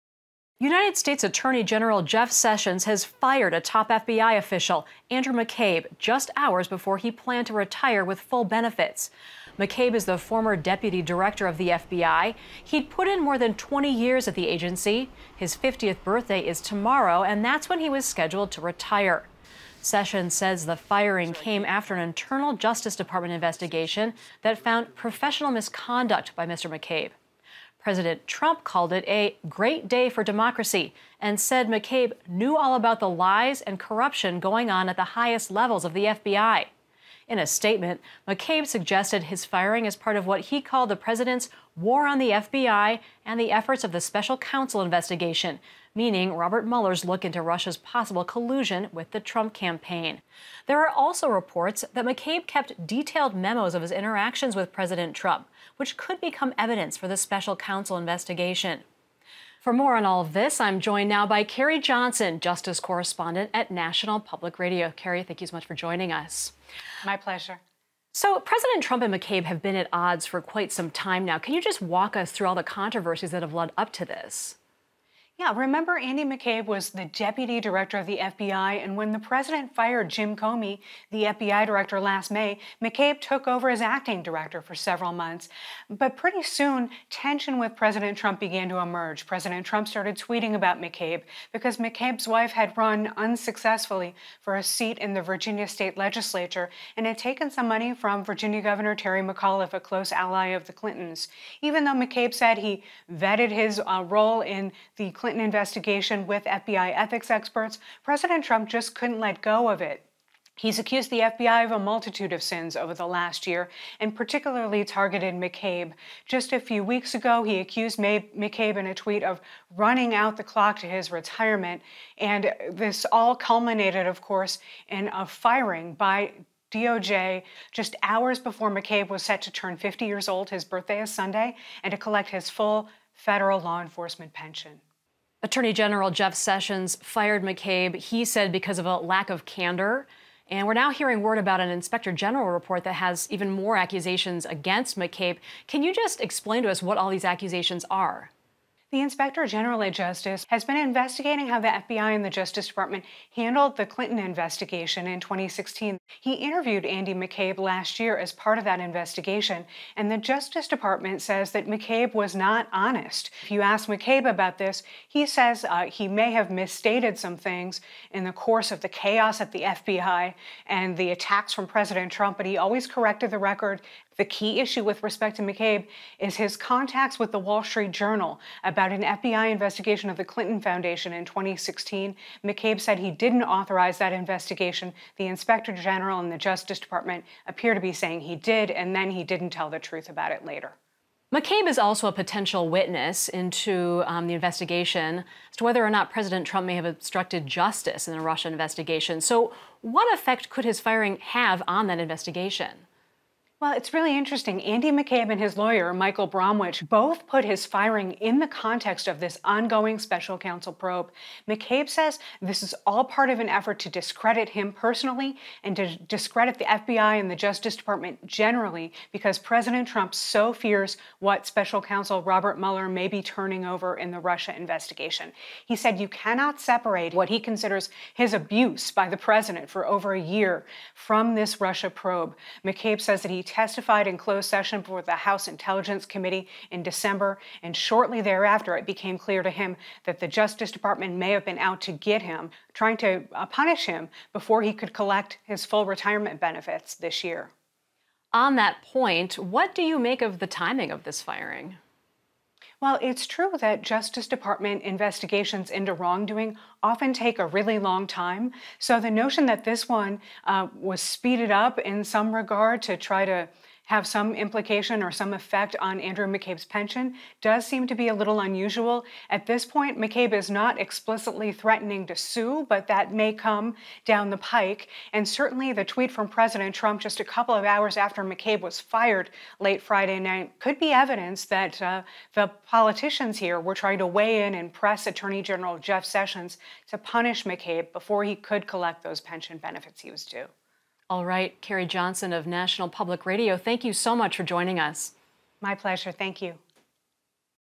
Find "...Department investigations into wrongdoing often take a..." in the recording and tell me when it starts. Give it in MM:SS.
04:14.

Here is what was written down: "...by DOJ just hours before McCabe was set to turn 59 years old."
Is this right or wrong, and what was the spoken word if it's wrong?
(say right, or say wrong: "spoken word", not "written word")
wrong: "50", not "59".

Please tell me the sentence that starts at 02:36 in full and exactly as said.
He interviewed Andy McCabe last year as part of that investigation, and the Justice Department says that McCabe was not honest.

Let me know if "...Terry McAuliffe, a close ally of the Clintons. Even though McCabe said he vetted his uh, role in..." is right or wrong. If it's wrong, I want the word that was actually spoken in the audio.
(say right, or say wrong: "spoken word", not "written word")
right.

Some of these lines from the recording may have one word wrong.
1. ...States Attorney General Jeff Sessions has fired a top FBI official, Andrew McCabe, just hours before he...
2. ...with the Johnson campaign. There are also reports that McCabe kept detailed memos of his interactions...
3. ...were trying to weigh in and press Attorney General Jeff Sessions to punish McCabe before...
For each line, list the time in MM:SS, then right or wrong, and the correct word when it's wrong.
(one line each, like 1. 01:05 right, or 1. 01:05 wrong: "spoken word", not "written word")
1. 00:00 right
2. 00:48 wrong: "Trump", not "Johnson"
3. 04:43 right.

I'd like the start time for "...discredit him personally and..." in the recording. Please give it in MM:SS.
03:33.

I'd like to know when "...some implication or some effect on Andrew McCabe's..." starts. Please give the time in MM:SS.
04:24.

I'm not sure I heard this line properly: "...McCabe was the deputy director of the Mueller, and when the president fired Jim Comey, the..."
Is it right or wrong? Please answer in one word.
wrong.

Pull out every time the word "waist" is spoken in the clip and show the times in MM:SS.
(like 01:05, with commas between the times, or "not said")
not said.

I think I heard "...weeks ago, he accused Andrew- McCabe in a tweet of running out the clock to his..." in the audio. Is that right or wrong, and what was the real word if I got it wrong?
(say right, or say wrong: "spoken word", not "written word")
wrong: "May", not "Andrew".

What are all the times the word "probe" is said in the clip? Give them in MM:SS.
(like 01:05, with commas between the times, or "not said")
03:30, 03:51.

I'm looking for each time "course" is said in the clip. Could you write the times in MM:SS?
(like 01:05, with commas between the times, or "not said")
02:04, 02:48.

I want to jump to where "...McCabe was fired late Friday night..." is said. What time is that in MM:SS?
04:38.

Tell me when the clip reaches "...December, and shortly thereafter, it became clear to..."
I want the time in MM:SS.
03:56.